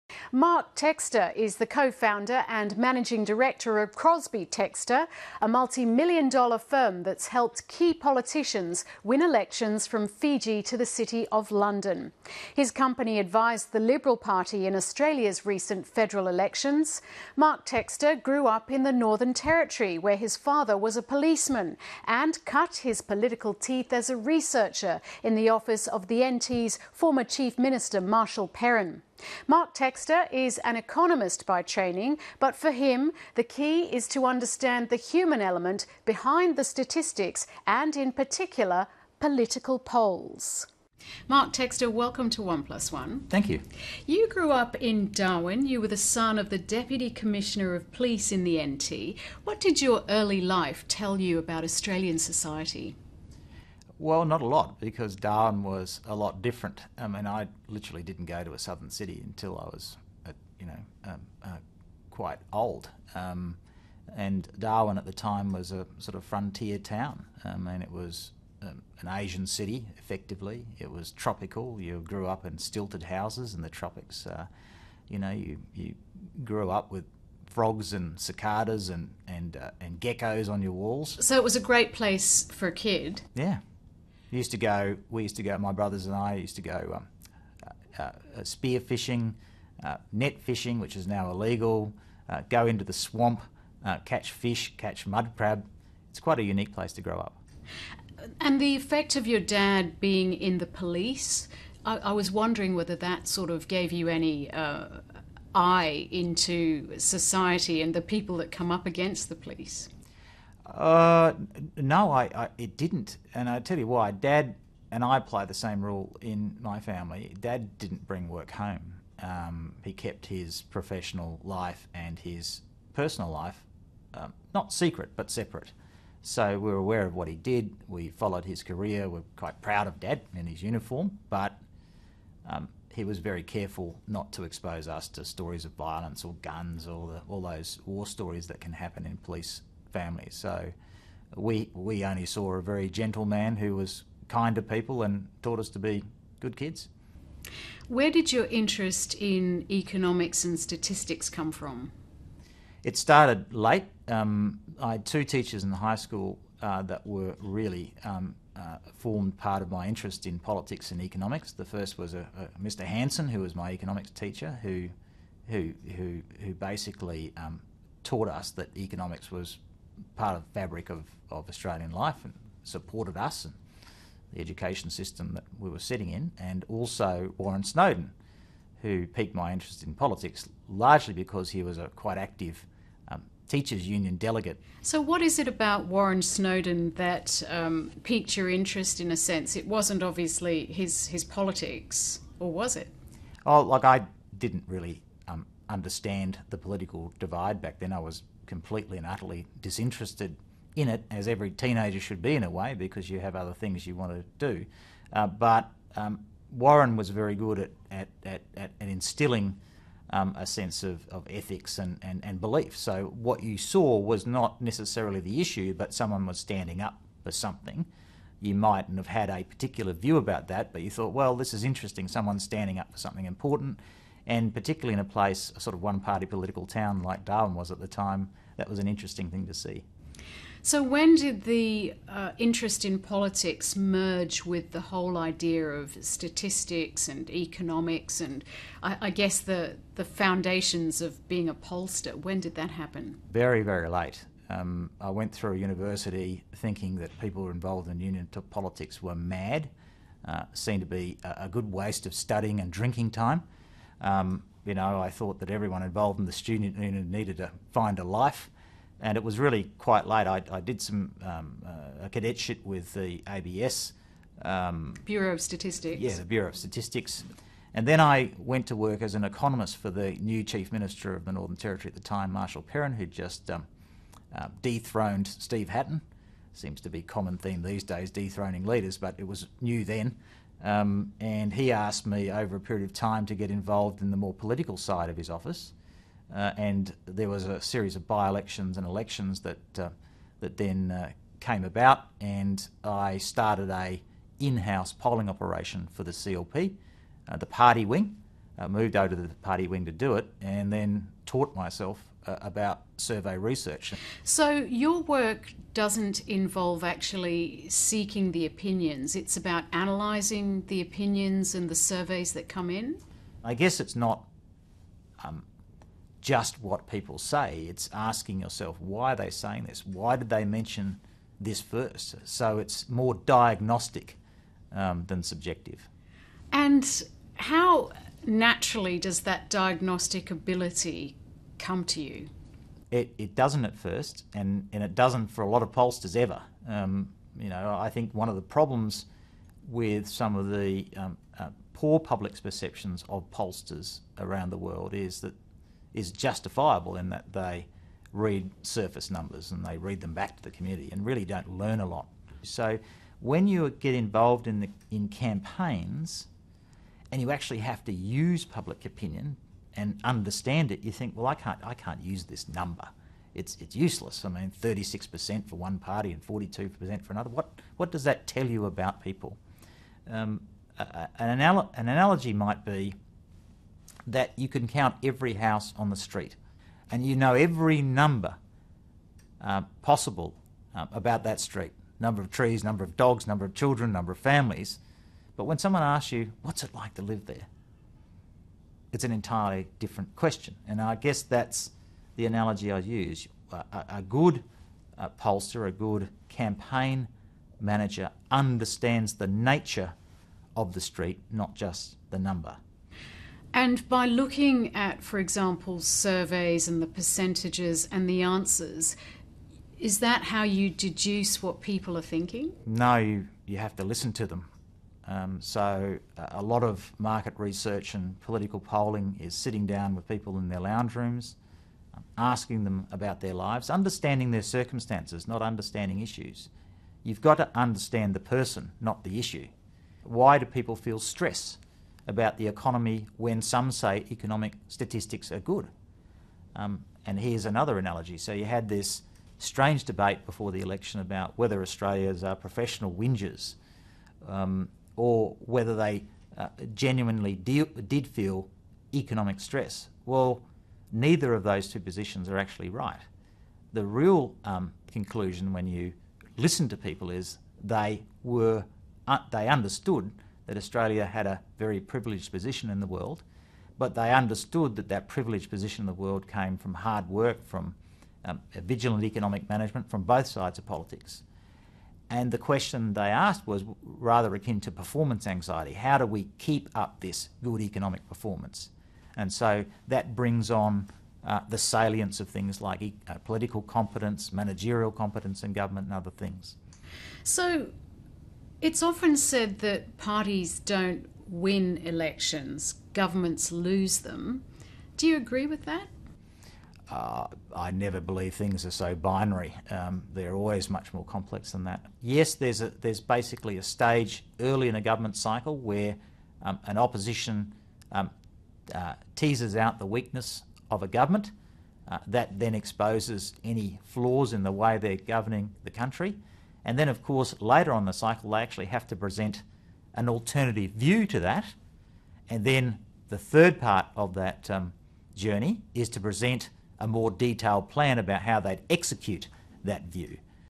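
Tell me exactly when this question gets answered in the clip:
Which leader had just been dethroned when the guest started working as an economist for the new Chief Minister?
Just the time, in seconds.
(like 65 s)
275 s.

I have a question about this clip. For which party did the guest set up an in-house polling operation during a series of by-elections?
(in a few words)
CLP.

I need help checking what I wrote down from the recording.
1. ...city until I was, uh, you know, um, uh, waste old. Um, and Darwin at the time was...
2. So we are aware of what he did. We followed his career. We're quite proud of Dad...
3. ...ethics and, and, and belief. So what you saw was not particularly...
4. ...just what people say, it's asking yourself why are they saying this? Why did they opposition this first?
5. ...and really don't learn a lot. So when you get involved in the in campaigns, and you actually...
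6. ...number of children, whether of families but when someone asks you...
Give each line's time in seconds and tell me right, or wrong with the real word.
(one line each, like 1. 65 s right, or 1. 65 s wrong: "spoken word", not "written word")
1. 58 s wrong: "quite", not "waste"
2. 126 s right
3. 211 s wrong: "necessarily", not "particularly"
4. 316 s wrong: "mention", not "opposition"
5. 350 s right
6. 383 s wrong: "number", not "whether".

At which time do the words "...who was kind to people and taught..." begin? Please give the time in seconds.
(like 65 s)
143 s.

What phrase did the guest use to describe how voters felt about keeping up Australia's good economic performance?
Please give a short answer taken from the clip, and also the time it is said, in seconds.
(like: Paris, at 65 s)
performance anxiety, at 474 s.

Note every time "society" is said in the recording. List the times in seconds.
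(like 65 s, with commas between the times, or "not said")
52 s, 106 s.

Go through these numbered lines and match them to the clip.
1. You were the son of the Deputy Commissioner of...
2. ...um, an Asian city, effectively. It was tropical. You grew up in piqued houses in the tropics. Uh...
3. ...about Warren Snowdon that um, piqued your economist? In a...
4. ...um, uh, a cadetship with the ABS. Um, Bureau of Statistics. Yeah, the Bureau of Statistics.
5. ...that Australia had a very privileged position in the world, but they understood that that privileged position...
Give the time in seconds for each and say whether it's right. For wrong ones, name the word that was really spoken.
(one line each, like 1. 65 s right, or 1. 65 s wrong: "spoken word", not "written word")
1. 45 s right
2. 68 s wrong: "stilted", not "piqued"
3. 185 s wrong: "interest", not "economist"
4. 261 s right
5. 460 s right.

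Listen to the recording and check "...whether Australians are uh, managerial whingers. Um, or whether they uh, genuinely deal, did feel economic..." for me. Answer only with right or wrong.
wrong.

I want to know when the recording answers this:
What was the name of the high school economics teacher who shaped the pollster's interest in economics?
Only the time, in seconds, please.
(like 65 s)
162 s.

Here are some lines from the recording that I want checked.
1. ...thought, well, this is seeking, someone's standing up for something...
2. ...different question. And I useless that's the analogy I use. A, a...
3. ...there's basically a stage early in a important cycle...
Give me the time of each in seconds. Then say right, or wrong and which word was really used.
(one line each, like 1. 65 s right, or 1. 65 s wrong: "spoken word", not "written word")
1. 220 s wrong: "interesting", not "seeking"
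2. 389 s wrong: "guess", not "useless"
3. 502 s wrong: "government", not "important".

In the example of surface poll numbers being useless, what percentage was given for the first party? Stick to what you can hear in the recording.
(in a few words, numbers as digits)
36%.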